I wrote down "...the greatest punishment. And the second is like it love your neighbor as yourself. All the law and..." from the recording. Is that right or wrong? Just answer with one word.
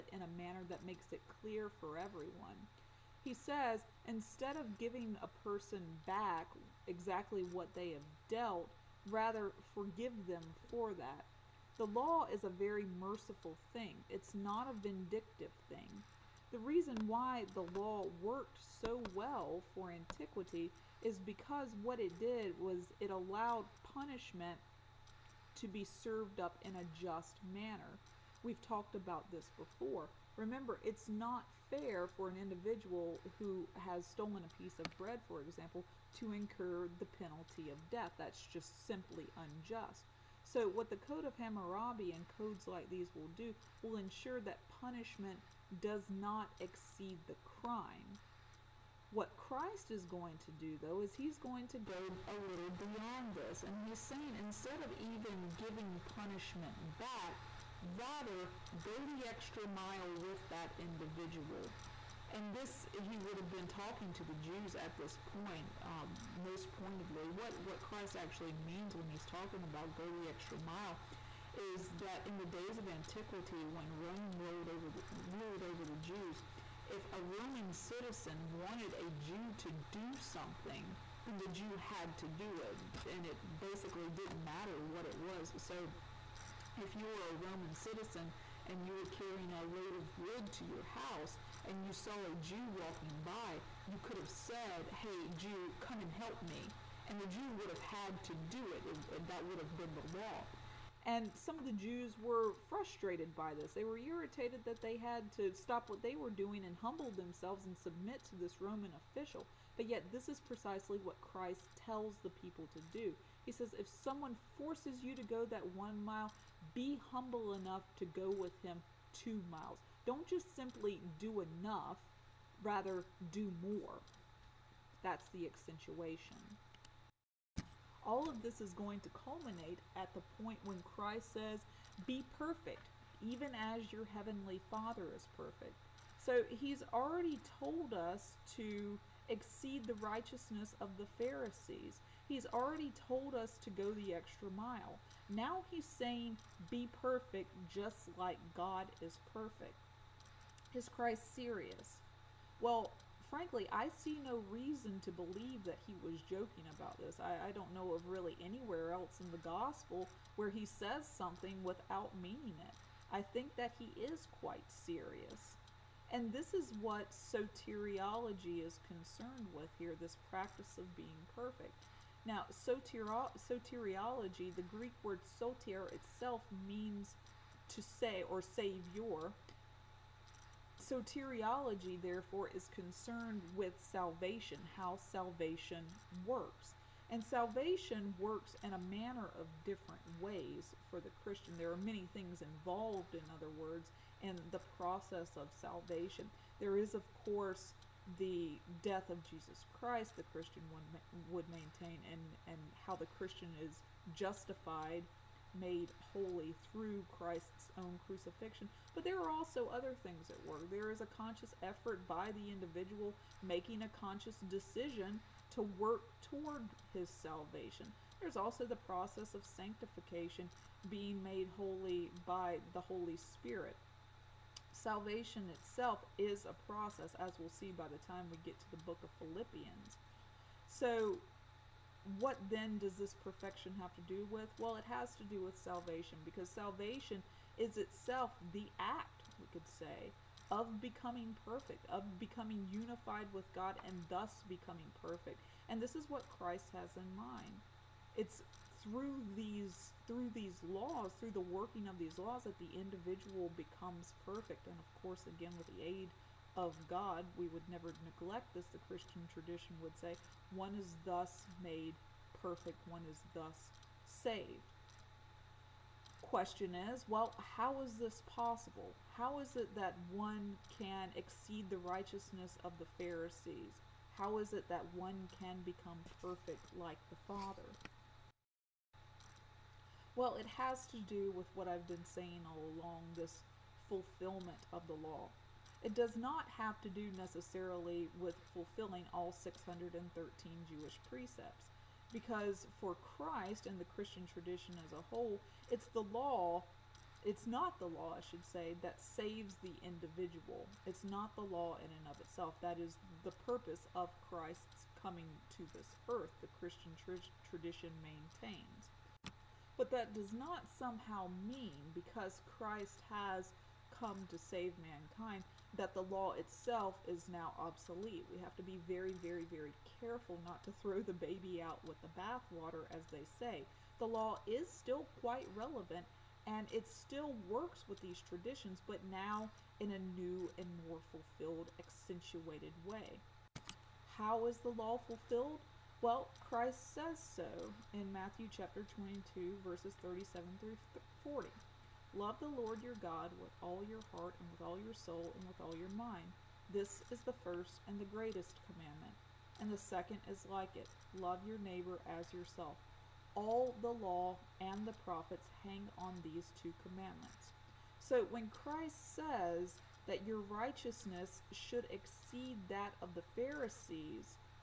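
wrong.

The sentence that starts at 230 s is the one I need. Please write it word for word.
So what then does this perfection have to do with?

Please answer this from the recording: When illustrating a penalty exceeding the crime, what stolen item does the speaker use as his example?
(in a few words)
a piece of bread.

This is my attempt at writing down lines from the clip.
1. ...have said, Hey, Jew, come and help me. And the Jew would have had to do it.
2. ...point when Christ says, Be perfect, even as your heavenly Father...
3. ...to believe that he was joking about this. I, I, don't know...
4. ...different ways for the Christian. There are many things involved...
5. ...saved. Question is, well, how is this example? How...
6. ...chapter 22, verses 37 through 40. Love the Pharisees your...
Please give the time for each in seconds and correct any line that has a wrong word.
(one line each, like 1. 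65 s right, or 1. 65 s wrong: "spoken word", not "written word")
1. 94 s right
2. 130 s right
3. 155 s right
4. 189 s right
5. 264 s wrong: "possible", not "example"
6. 338 s wrong: "Lord", not "Pharisees".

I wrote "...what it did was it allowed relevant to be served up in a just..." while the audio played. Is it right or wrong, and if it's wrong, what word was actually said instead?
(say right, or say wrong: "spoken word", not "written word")
wrong: "punishment", not "relevant".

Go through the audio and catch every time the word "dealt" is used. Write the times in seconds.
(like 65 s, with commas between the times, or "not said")
8 s.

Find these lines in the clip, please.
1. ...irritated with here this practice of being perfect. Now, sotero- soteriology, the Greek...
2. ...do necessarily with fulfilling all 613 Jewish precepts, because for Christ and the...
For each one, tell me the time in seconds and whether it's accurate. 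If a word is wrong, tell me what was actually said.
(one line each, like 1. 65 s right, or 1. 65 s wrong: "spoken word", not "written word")
1. 168 s wrong: "concerned", not "irritated"
2. 286 s right.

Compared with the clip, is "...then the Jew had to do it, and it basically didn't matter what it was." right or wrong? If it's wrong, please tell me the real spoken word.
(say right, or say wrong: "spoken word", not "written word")
right.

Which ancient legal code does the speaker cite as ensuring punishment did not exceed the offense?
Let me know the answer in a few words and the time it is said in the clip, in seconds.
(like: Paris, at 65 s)
Code of Hammurabi, at 40 s.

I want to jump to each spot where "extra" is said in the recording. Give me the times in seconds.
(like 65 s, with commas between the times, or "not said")
59 s, 70 s, 144 s.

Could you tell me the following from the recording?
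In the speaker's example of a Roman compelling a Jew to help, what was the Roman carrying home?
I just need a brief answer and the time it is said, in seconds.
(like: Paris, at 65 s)
a load of wood, at 89 s.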